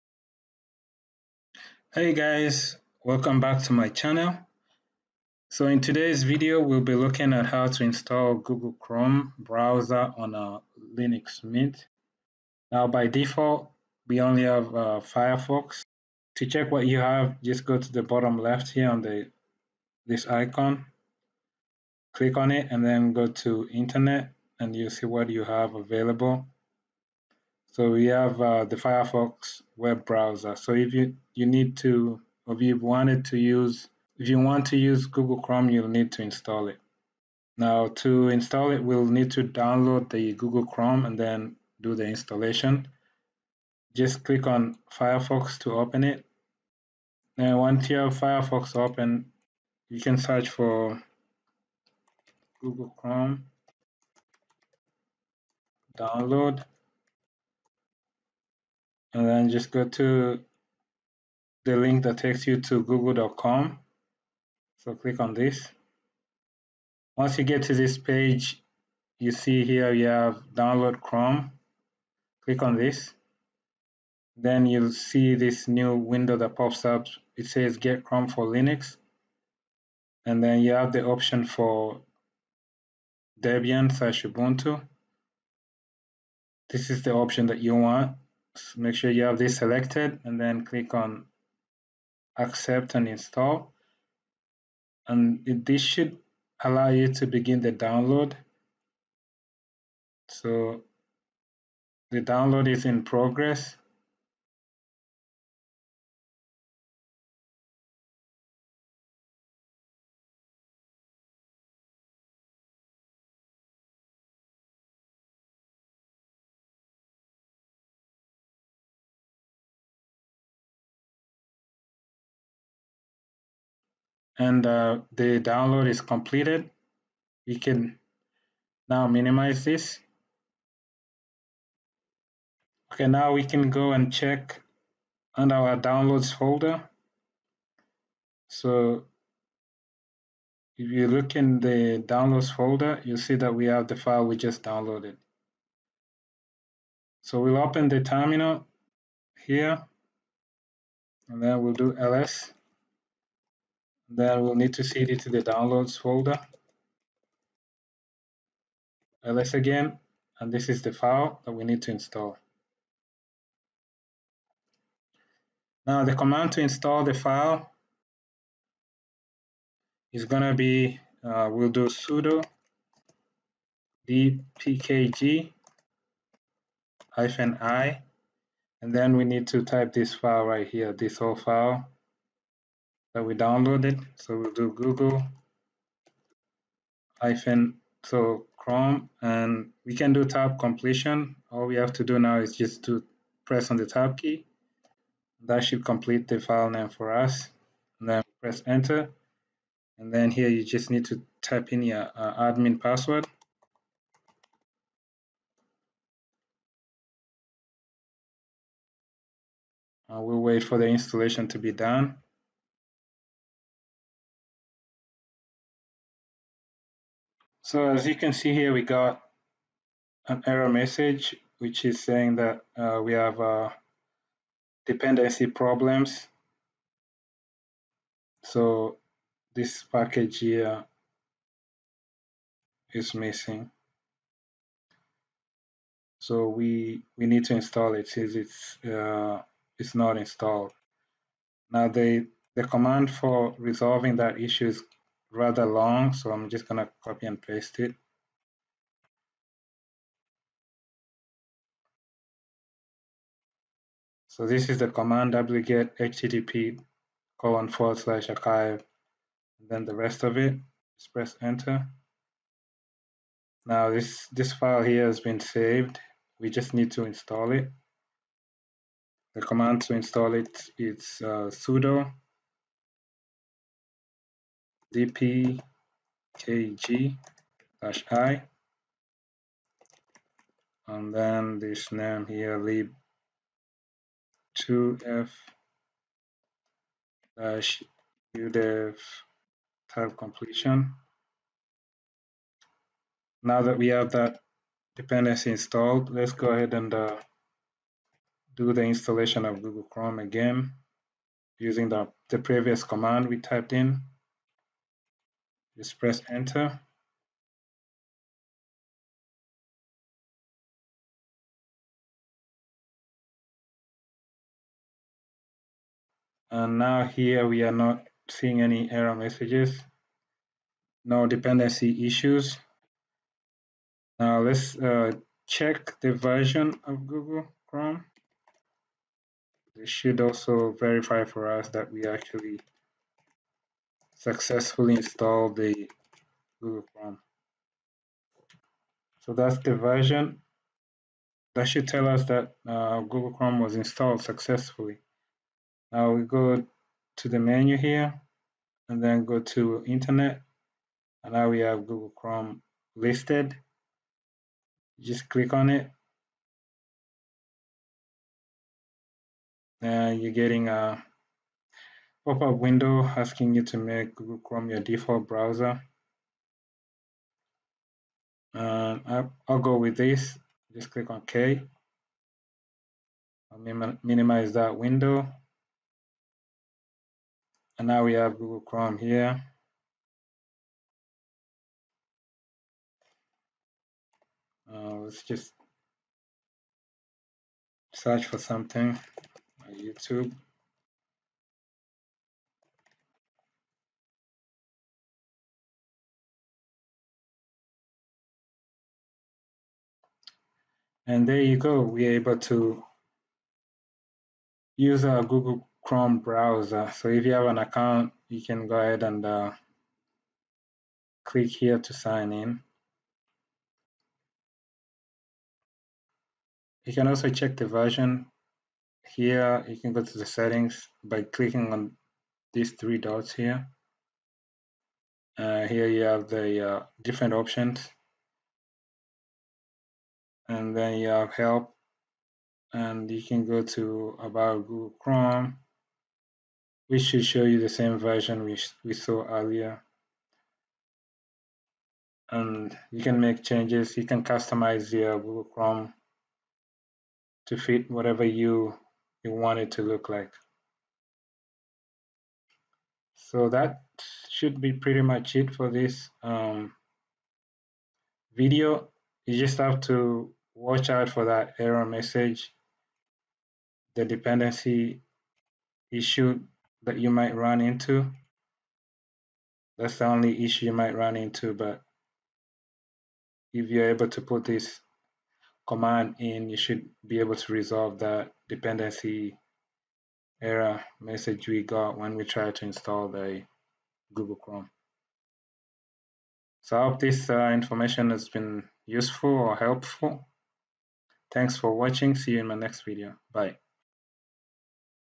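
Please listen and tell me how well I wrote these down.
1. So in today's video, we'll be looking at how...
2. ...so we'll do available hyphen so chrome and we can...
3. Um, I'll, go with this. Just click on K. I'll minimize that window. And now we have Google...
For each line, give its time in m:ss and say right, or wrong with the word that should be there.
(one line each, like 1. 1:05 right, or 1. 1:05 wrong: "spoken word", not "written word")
1. 0:05 right
2. 3:04 wrong: "google", not "available"
3. 6:08 right.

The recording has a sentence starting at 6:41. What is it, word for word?
And there you go, we're able to use our Google Chrome browser.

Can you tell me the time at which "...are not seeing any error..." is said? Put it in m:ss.
5:17.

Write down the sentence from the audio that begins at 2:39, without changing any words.
ls again, and this is the file that we need to install.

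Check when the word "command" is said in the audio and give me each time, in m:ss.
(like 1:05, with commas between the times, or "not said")
2:46, 4:02, 4:14, 4:29, 5:02, 7:55.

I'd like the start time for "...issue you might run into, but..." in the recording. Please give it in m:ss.
7:50.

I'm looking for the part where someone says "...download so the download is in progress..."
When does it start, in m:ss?
1:37.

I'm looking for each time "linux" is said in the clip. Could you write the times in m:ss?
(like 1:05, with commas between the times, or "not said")
0:10, 1:18.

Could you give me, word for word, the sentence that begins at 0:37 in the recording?
Now to install it, we'll need to download the Google Chrome and then do the installation.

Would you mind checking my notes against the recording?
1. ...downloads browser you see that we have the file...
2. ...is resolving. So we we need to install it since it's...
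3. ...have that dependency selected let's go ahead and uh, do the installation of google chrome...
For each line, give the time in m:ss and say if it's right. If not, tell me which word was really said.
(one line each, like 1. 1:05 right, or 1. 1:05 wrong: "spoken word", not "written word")
1. 2:22 wrong: "folder", not "browser"
2. 3:52 wrong: "missing", not "resolving"
3. 4:53 wrong: "installed", not "selected".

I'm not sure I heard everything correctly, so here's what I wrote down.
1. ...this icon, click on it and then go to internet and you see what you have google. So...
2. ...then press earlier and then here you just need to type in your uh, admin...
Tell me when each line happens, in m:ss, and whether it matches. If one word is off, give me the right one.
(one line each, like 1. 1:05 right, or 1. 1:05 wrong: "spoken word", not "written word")
1. 0:20 wrong: "available", not "google"
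2. 3:18 wrong: "enter", not "earlier".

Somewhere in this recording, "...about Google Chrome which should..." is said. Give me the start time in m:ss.
7:14.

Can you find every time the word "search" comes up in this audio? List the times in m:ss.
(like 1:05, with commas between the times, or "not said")
0:50, 6:27.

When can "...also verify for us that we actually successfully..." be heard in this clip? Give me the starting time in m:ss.
5:30.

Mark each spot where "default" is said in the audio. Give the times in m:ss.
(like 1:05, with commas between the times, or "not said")
0:13, 6:04.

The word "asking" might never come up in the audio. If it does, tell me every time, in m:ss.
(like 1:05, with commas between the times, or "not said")
6:03.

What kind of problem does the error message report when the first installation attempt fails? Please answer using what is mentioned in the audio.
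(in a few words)
Dependency problems.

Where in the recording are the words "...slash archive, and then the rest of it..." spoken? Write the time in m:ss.
4:17.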